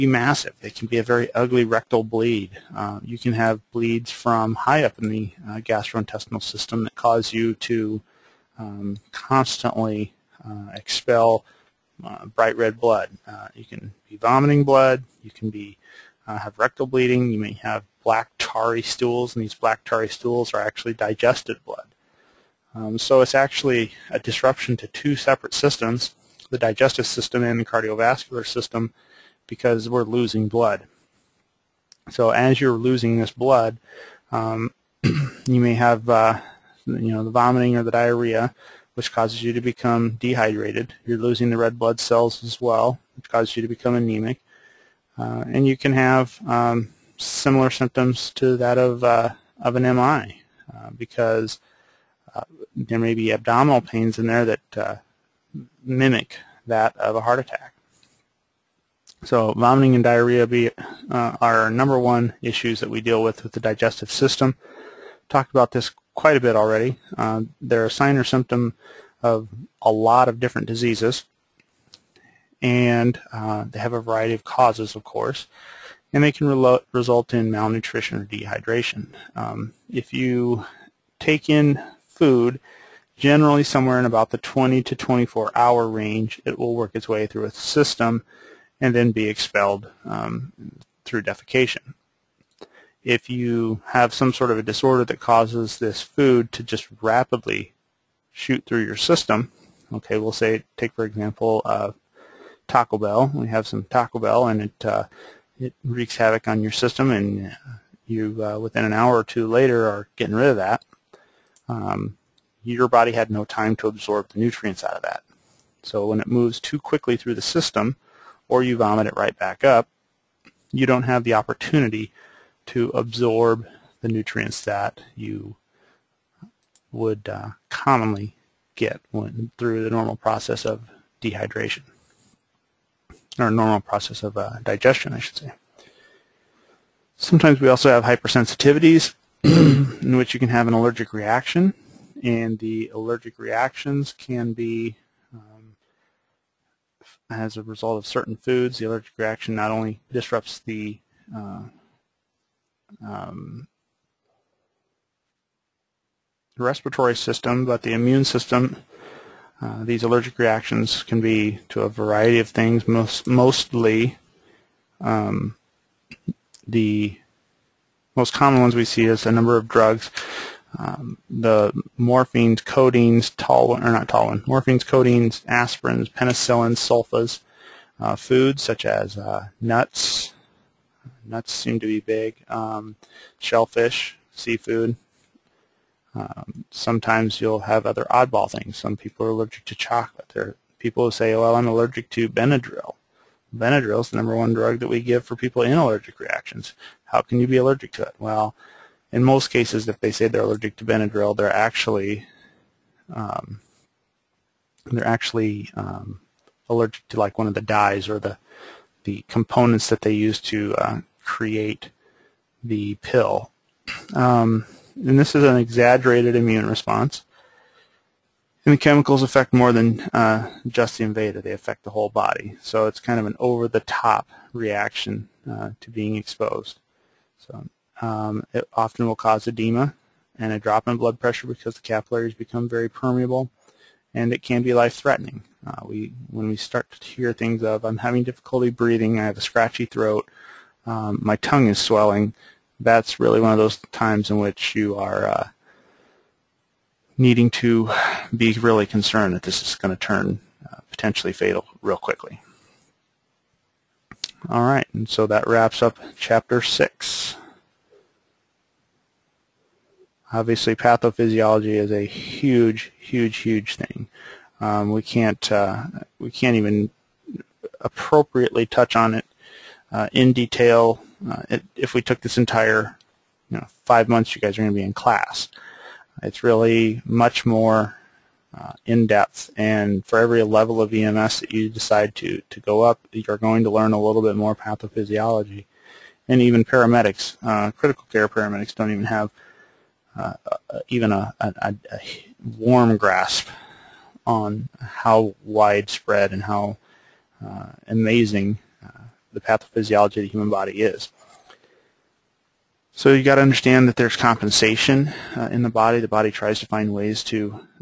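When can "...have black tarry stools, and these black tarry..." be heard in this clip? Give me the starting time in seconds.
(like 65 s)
17 s.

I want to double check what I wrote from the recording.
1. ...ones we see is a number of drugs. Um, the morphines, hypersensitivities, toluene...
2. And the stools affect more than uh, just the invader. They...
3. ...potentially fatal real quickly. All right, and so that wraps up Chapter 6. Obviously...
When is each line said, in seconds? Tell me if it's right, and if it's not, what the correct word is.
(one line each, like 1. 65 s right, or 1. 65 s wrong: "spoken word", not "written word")
1. 168 s wrong: "codeines", not "hypersensitivities"
2. 218 s wrong: "chemicals", not "stools"
3. 250 s right.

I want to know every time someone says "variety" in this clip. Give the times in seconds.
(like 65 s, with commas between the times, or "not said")
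74 s, 161 s.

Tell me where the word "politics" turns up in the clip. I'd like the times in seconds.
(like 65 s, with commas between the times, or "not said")
not said.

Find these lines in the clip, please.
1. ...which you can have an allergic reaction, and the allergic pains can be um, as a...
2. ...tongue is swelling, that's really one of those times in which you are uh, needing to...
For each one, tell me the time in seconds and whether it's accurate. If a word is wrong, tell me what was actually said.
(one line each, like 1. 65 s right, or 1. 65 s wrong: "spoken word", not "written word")
1. 140 s wrong: "reactions", not "pains"
2. 241 s right.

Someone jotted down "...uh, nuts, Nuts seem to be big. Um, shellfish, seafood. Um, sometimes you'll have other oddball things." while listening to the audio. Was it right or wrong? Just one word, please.
right.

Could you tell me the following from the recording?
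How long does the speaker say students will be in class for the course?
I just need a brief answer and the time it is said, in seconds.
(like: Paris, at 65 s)
Five months, at 273 s.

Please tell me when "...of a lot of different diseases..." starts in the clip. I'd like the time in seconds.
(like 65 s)
69 s.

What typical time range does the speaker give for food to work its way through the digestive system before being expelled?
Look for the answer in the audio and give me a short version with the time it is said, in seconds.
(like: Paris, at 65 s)
20 to 24 hours, at 84 s.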